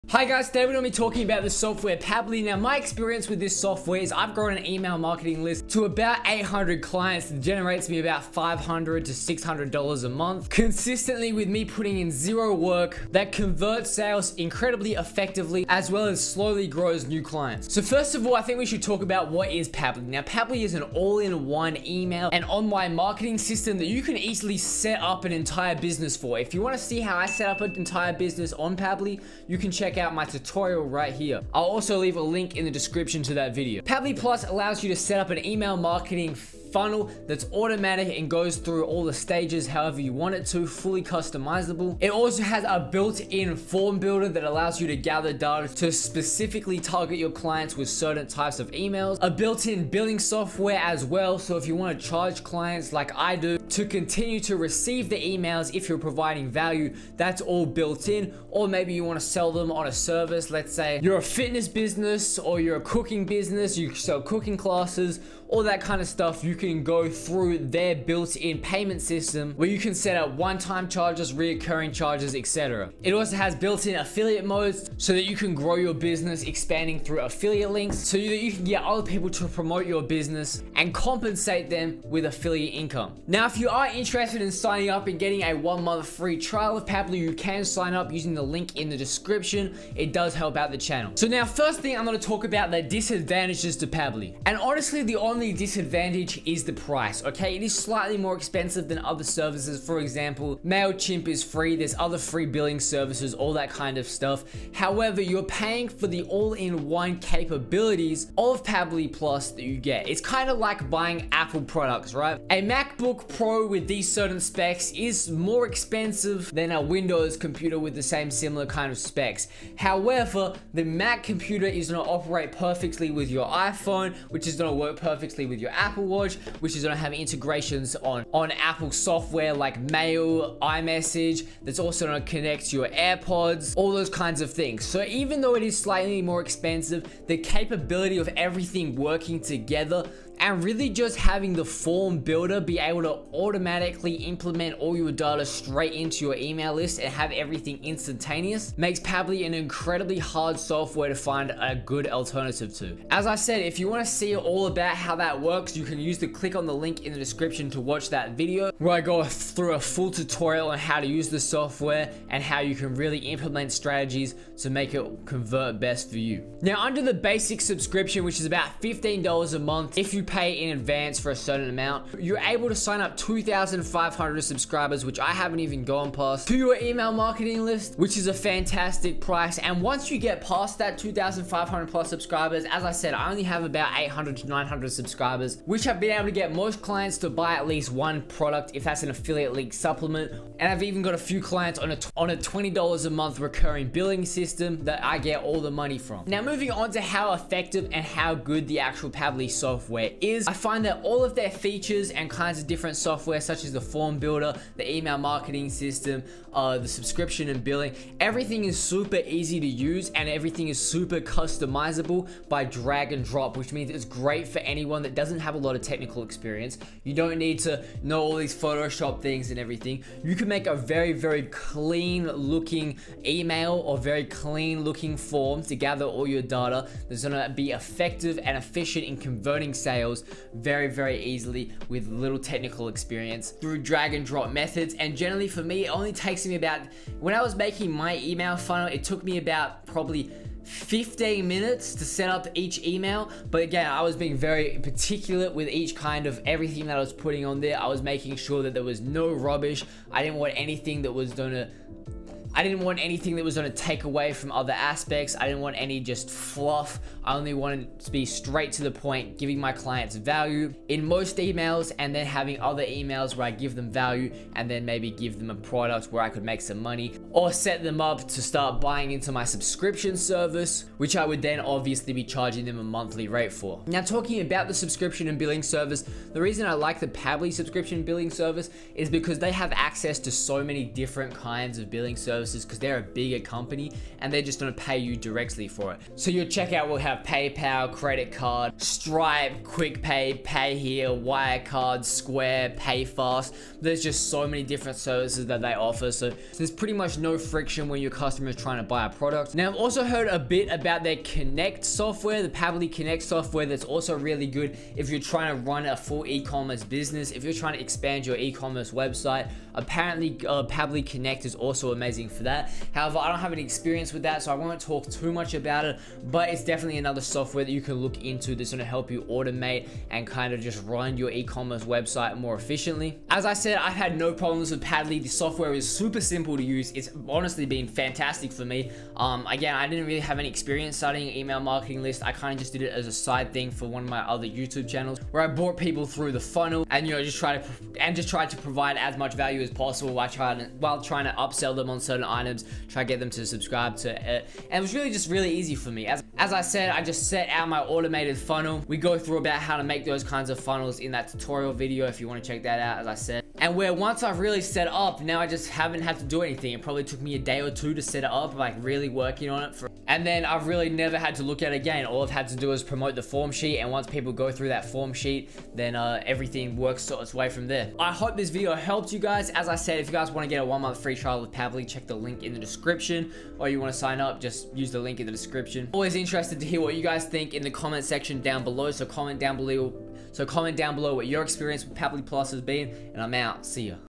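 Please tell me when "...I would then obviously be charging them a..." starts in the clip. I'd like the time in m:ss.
4:31.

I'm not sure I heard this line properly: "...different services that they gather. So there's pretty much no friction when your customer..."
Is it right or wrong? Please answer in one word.
wrong.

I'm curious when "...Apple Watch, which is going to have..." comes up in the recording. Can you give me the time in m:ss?
2:05.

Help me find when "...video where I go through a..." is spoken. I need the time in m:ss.
2:38.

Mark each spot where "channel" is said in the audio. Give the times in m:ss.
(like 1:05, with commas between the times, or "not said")
1:30, 5:34.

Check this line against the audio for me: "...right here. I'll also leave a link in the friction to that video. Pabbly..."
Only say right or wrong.
wrong.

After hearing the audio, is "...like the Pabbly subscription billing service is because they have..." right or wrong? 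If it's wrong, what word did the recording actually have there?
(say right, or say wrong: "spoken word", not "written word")
right.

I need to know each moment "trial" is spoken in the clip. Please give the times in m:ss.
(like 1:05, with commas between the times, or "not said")
1:26, 6:11.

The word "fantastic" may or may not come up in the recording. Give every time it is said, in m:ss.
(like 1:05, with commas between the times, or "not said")
2:58, 5:27.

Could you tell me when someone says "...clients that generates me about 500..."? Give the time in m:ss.
0:06.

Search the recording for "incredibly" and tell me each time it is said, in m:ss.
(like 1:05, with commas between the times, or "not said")
0:14, 2:29.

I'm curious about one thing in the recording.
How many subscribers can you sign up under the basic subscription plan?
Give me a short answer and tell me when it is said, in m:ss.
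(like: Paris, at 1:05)
2,500, at 2:53.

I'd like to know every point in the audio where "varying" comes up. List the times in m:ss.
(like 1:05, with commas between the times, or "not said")
not said.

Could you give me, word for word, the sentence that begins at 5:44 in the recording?
And it was really just really easy for me.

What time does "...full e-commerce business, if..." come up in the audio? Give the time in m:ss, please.
5:05.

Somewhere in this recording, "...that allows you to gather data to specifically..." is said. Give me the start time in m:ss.
0:44.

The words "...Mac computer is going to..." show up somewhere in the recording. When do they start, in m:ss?
2:00.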